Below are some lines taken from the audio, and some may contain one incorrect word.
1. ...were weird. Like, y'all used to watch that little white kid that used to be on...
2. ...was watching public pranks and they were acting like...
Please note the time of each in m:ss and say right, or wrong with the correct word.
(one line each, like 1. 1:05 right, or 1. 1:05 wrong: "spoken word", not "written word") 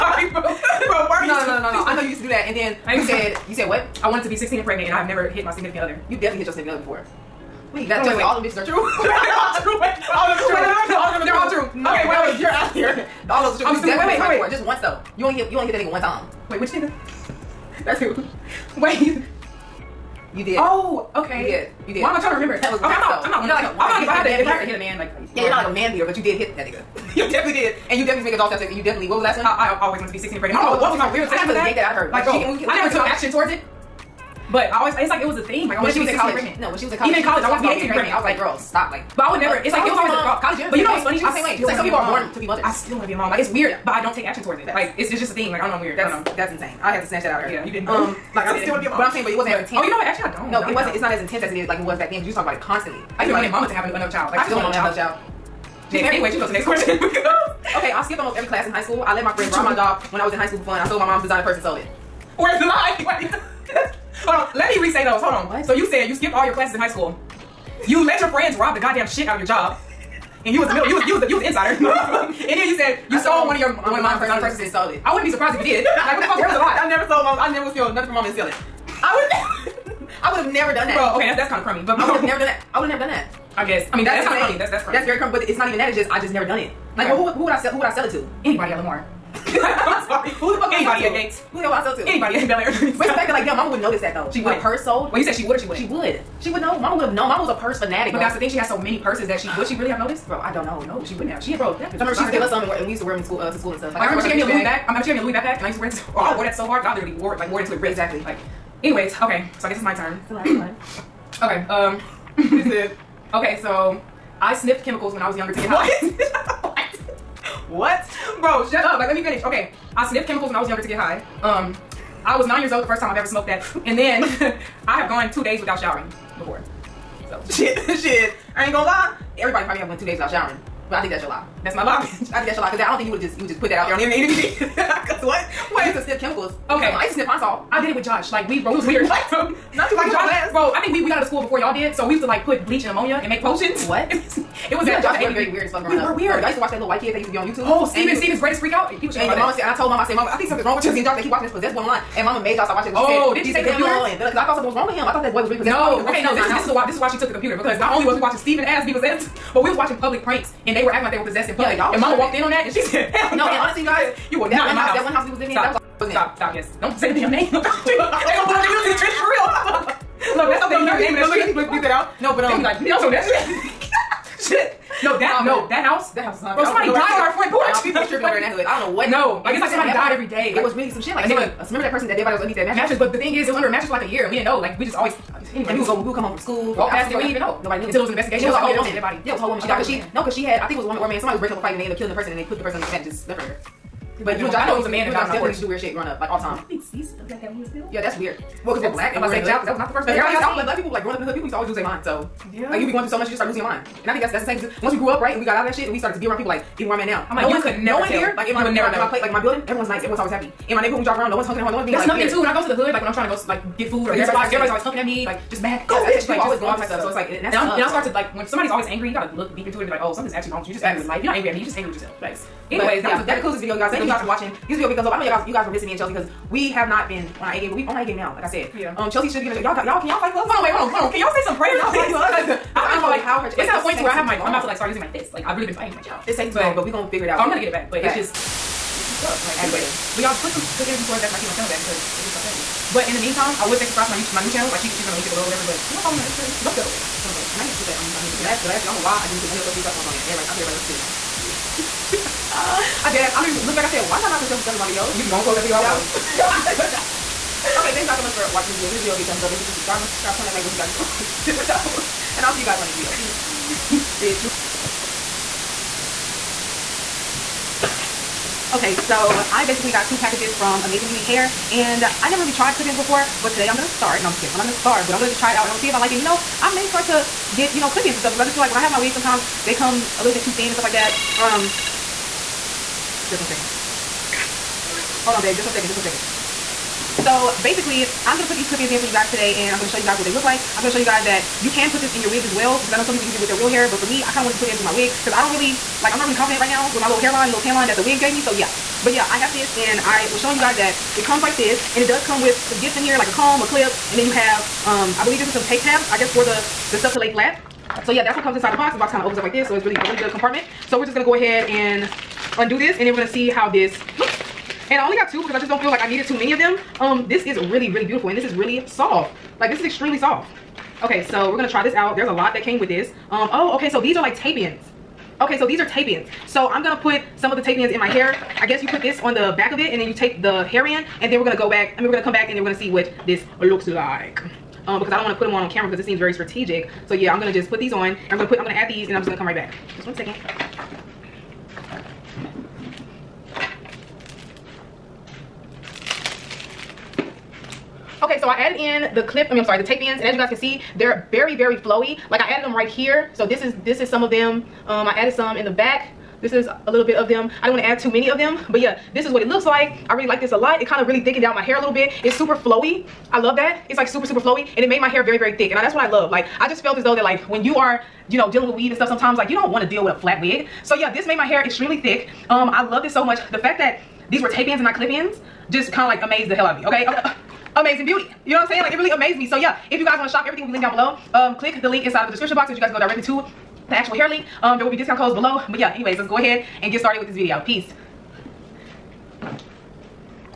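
1. 2:26 right
2. 2:39 right.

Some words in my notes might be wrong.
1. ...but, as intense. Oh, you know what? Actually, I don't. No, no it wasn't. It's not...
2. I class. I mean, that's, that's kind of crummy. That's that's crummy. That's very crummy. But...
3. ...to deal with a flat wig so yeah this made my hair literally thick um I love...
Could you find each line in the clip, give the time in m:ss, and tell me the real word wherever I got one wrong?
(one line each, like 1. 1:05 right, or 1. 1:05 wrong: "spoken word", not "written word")
1. 0:49 right
2. 1:23 wrong: "guess", not "class"
3. 6:09 wrong: "extremely", not "literally".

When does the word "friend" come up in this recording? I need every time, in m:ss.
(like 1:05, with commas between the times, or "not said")
0:59, 1:08.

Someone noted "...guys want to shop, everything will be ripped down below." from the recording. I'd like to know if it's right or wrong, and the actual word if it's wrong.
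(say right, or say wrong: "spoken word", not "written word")
wrong: "linked", not "ripped".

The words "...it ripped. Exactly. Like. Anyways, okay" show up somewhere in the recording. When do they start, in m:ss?
1:47.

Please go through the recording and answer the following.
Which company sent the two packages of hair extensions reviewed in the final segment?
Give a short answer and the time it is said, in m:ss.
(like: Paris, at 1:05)
Amazing Beauty Hair, at 4:30.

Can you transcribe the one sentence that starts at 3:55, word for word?
Like I've really been fighting for my child.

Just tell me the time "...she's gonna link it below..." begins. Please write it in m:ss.
4:04.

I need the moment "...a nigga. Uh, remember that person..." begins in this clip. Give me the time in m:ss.
3:01.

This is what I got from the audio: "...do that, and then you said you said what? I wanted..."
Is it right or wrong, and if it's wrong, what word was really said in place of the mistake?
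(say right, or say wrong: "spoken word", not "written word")
right.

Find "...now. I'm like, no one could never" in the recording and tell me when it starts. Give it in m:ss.
3:27.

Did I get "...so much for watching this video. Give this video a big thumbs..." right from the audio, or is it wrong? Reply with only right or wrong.
right.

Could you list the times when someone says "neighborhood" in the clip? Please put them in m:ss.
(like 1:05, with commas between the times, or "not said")
3:30.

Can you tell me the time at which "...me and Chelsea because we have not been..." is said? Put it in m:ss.
3:45.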